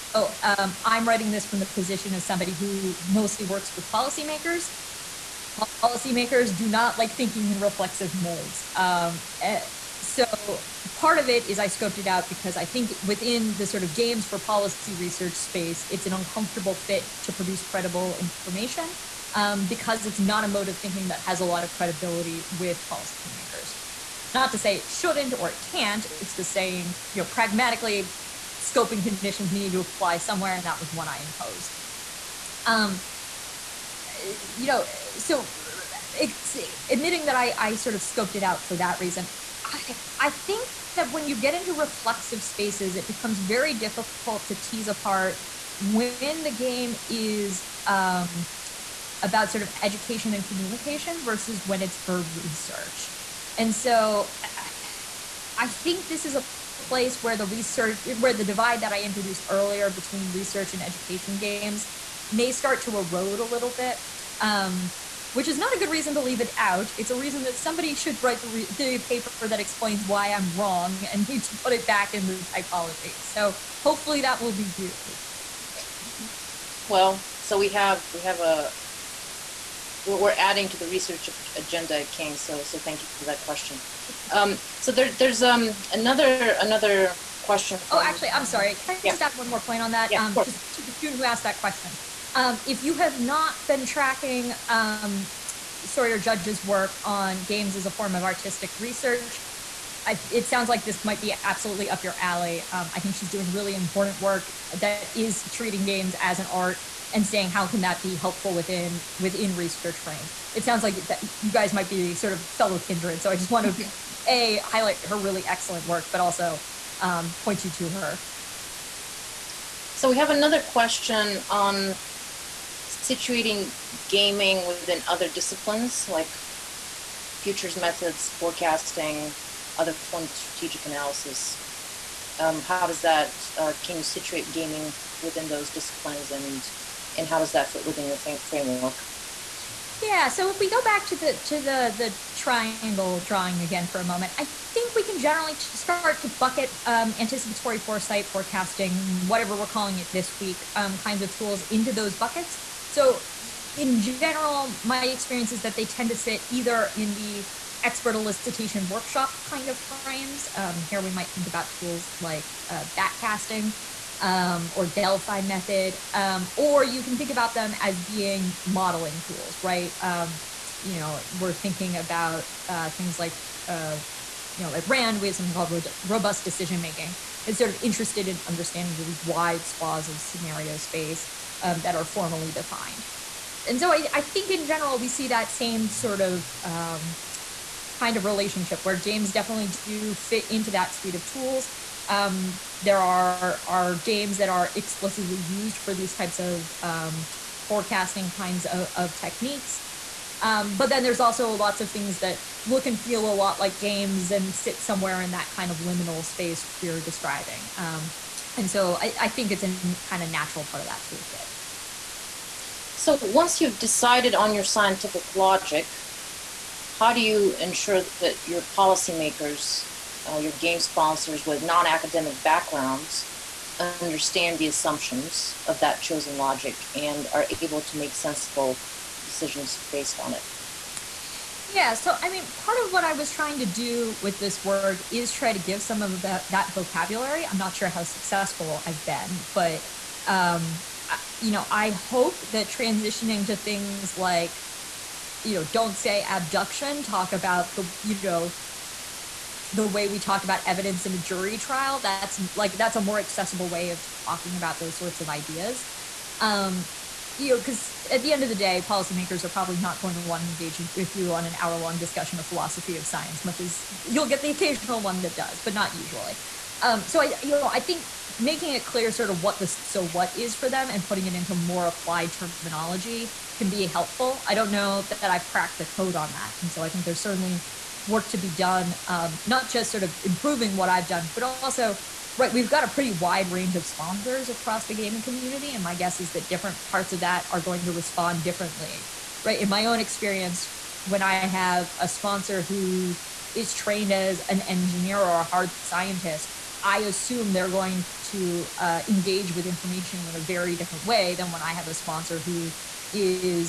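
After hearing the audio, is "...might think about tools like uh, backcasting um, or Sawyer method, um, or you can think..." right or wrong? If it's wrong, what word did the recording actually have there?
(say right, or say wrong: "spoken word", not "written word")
wrong: "Delphi", not "Sawyer".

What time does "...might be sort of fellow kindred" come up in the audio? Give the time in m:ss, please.
1:51.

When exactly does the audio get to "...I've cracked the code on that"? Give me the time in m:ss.
4:35.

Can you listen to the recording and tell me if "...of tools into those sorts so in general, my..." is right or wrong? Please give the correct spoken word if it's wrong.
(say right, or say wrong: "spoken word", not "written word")
wrong: "buckets", not "sorts".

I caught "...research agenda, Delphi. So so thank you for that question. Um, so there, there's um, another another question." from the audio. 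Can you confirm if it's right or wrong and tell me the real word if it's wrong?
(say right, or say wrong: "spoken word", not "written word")
wrong: "King", not "Delphi".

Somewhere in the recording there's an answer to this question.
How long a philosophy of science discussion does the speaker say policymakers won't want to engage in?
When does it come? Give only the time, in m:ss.
4:21.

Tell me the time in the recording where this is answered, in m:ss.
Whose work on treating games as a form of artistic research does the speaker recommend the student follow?
1:35.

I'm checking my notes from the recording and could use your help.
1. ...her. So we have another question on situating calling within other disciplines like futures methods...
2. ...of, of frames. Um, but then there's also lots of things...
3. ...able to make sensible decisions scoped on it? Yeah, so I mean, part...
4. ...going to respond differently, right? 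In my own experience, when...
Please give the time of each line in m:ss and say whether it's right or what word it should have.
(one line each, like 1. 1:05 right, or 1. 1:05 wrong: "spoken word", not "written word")
1. 1:57 wrong: "gaming", not "calling"
2. 3:18 wrong: "techniques", not "frames"
3. 3:47 wrong: "based", not "scoped"
4. 4:47 right.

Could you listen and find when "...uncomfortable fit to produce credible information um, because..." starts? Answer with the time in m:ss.
0:16.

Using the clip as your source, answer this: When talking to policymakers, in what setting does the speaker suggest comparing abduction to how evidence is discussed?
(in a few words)
A jury trial.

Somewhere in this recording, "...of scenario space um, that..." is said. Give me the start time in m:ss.
3:00.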